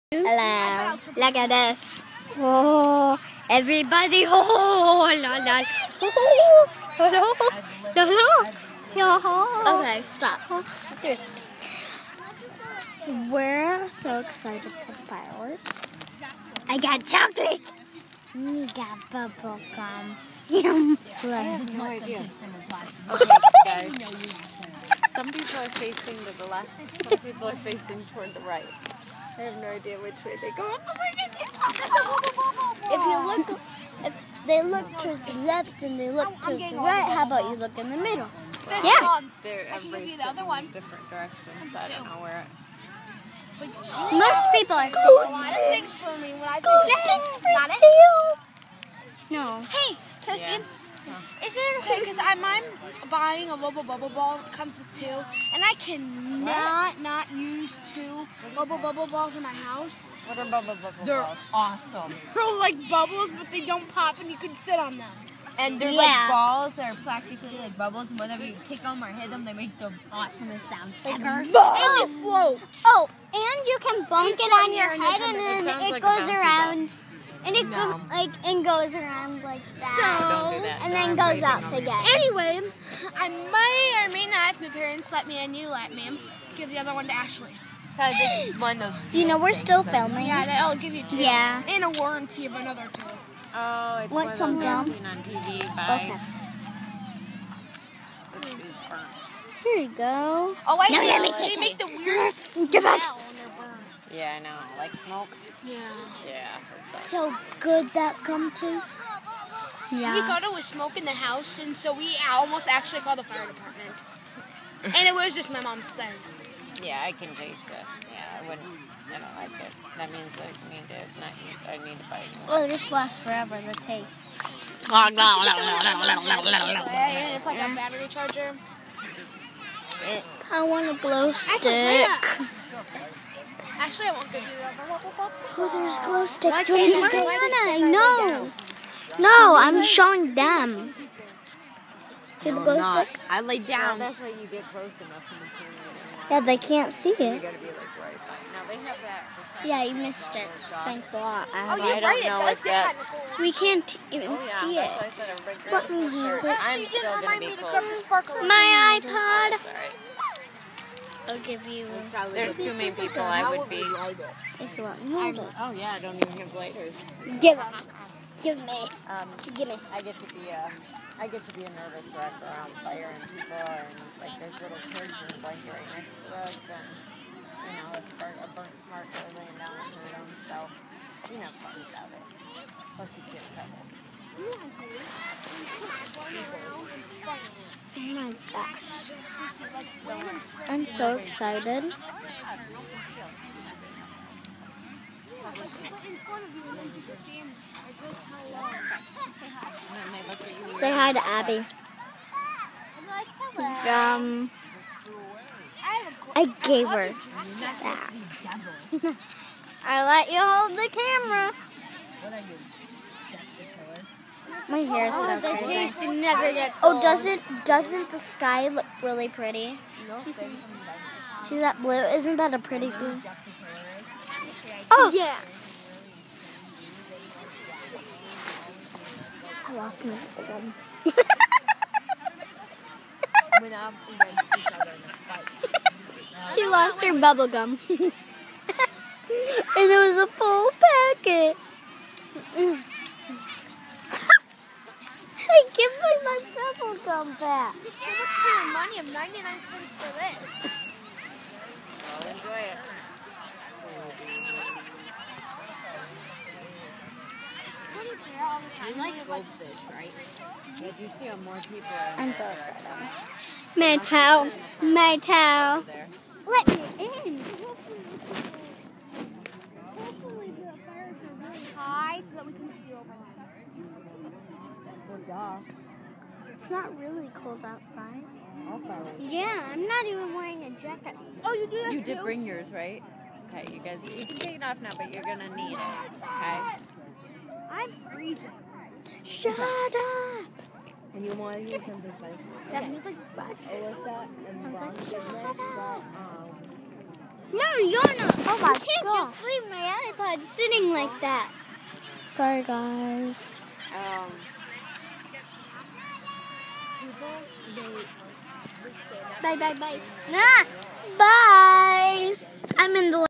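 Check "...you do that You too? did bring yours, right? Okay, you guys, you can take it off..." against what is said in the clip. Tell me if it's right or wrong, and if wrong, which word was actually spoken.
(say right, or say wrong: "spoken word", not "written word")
right.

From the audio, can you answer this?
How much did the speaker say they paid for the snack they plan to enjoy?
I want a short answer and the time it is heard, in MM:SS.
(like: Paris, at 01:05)
99 cents, at 04:09.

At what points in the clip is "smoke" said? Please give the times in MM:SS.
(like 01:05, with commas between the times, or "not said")
01:44, 01:50.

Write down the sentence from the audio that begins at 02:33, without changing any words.
We can't even oh, yeah, see it.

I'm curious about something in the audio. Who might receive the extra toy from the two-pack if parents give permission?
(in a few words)
Ashley.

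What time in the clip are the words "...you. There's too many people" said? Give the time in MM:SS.
02:41.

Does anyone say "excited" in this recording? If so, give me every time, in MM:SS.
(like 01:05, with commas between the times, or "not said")
00:14, 03:11, 04:22.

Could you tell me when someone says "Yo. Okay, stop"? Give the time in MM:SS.
00:08.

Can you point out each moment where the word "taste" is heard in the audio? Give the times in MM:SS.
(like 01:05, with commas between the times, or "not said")
01:48, 01:57, 02:03, 03:35.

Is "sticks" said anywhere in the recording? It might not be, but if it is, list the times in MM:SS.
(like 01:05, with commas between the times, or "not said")
02:11, 02:16, 02:22.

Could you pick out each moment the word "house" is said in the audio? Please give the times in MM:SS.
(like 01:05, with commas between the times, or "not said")
00:59, 01:51.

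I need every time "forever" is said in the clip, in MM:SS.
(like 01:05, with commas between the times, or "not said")
02:03.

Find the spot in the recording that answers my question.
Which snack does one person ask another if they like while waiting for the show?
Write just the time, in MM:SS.
04:19.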